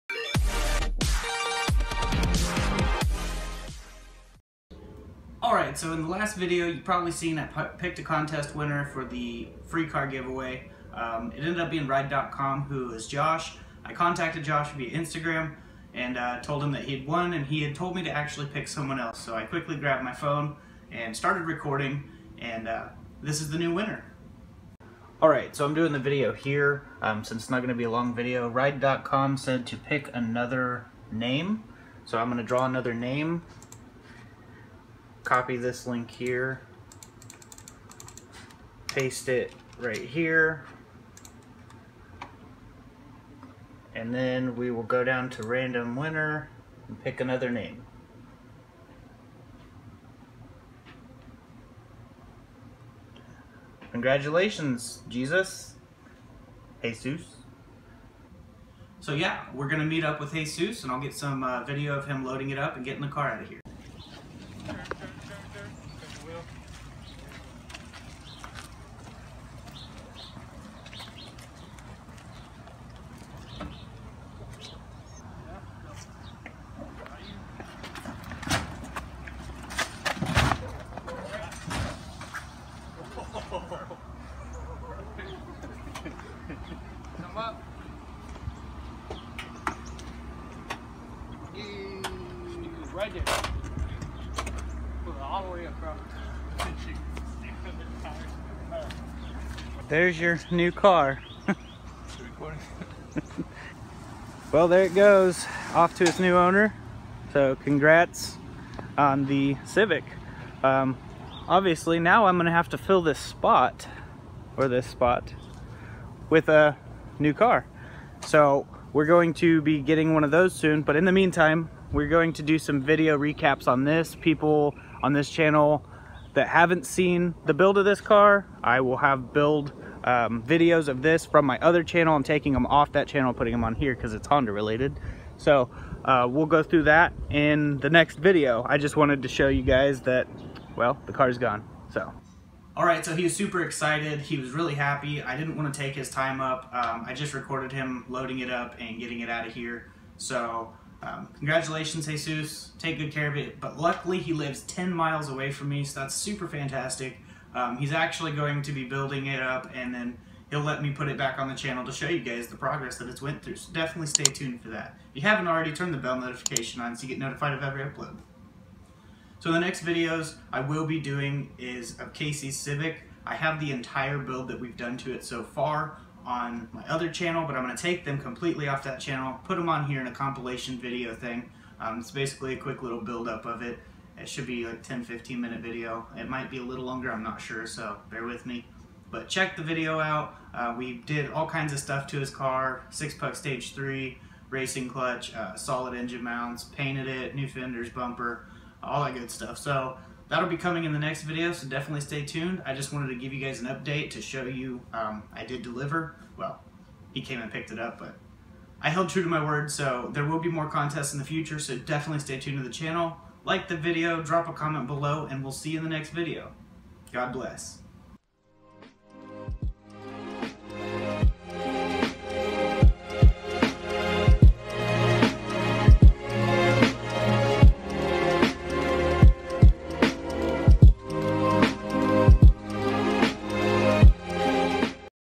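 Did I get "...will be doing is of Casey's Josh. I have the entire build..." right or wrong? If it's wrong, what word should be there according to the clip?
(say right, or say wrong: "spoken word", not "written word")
wrong: "Civic", not "Josh".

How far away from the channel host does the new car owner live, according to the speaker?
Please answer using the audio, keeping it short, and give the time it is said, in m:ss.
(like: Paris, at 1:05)
10 miles, at 2:34.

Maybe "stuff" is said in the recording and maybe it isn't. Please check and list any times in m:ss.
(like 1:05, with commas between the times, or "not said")
3:11, 3:19.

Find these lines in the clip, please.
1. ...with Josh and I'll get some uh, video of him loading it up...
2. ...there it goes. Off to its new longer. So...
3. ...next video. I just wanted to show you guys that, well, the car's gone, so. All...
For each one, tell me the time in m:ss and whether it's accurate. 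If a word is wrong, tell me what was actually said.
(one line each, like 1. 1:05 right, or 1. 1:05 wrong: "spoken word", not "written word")
1. 1:00 wrong: "Jesus", not "Josh"
2. 1:44 wrong: "owner", not "longer"
3. 2:17 right.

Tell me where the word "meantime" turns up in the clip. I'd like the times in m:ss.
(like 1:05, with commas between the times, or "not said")
2:01.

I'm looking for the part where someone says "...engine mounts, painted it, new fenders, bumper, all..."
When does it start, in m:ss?
3:15.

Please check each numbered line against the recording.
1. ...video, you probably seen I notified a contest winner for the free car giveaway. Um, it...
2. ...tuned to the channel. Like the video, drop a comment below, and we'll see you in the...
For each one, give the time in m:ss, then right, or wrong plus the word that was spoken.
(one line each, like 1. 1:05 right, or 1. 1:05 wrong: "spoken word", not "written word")
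1. 0:06 wrong: "picked", not "notified"
2. 3:32 right.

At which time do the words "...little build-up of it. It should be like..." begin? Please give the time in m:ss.
3:02.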